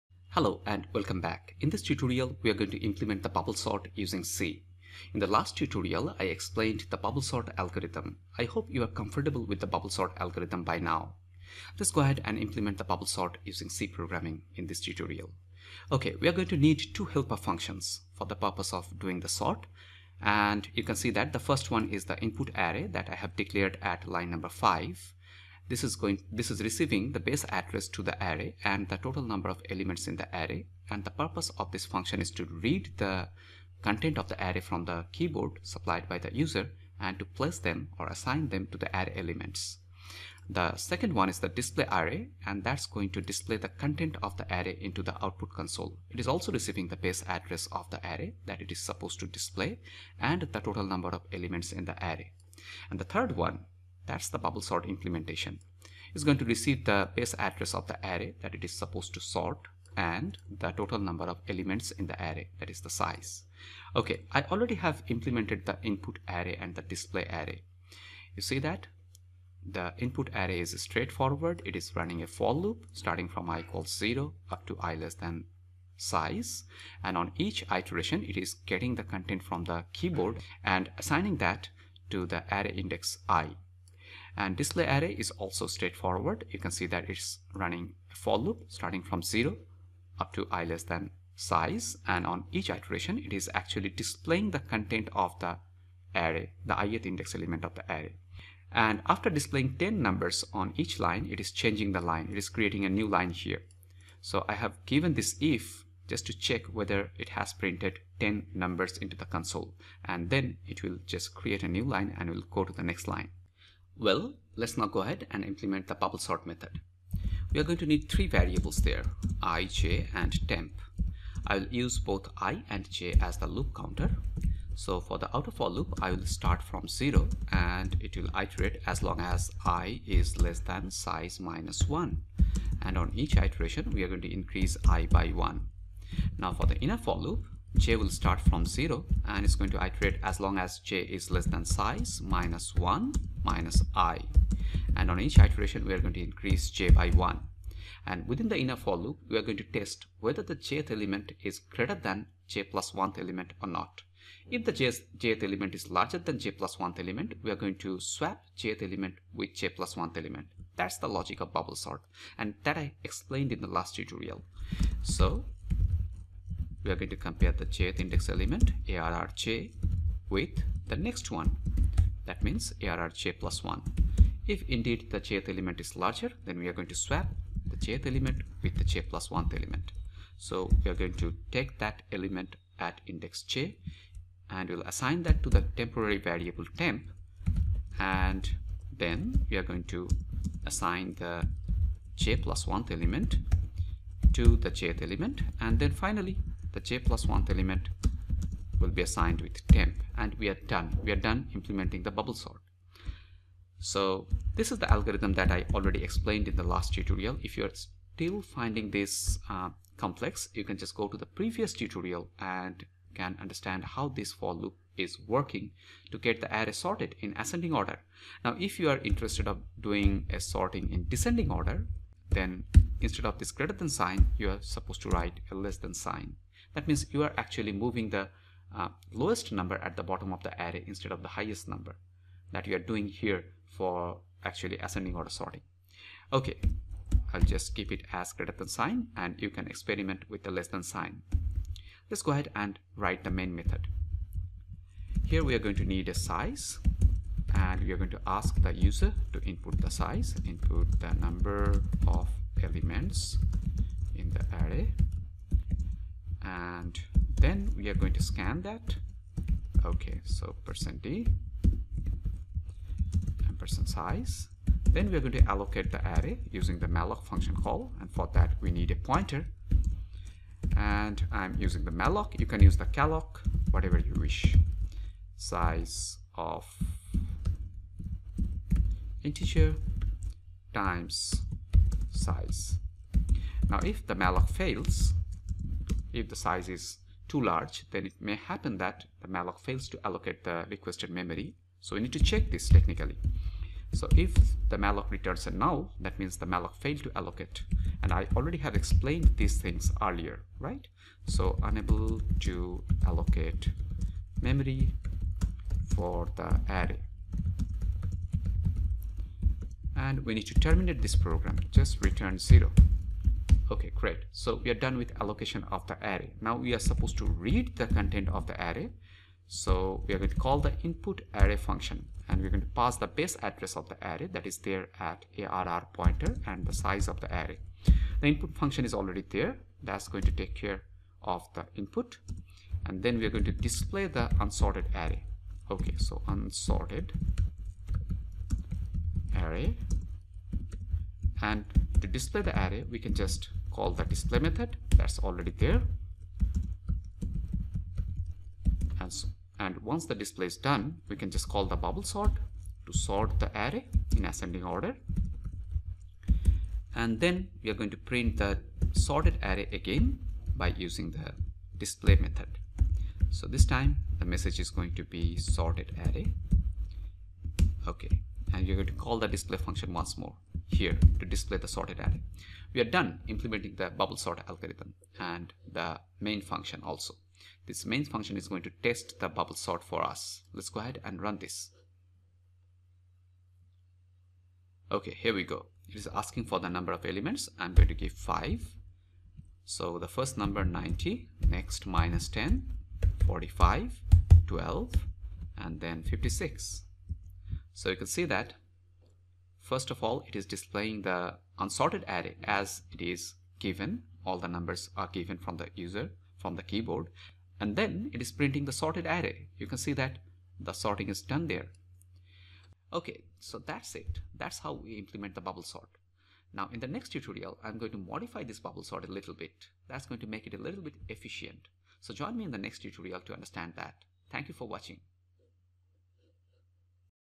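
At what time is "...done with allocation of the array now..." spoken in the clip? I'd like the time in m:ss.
5:14.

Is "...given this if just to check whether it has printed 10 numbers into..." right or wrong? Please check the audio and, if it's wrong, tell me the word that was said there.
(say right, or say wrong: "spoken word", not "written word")
right.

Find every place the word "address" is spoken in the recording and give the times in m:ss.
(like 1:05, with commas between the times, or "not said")
0:27, 0:47, 0:57, 5:23.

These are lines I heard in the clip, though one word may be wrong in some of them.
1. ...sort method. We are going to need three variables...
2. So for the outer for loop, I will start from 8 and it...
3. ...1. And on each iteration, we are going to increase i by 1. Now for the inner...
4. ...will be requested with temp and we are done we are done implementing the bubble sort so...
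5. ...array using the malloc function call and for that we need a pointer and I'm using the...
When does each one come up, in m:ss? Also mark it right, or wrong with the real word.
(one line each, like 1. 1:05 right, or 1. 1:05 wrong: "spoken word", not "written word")
1. 1:56 right
2. 2:04 wrong: "0", not "8"
3. 2:11 right
4. 3:18 wrong: "assigned", not "requested"
5. 4:26 right.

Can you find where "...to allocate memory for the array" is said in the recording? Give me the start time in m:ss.
5:02.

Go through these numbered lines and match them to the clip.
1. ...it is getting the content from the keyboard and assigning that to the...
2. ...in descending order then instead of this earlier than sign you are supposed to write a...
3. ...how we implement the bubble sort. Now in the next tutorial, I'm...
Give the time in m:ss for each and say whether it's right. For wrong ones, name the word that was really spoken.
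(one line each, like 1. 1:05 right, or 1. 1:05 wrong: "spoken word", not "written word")
1. 1:18 right
2. 3:40 wrong: "greater", not "earlier"
3. 6:54 right.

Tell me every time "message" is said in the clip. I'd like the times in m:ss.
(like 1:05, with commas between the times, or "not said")
6:04.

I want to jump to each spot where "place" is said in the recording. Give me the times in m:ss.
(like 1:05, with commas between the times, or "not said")
0:37.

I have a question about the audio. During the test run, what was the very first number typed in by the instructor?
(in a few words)
90.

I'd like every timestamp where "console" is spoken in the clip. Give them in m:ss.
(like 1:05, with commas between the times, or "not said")
0:45, 1:49.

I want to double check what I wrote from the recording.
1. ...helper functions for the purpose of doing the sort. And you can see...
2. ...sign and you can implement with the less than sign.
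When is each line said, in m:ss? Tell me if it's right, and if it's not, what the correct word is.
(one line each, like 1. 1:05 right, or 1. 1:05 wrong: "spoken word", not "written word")
1. 0:17 right
2. 3:58 wrong: "experiment", not "implement".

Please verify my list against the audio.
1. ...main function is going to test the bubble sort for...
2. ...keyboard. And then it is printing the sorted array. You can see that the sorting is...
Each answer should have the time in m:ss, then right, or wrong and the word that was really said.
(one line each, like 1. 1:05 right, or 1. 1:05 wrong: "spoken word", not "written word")
1. 6:17 right
2. 6:46 right.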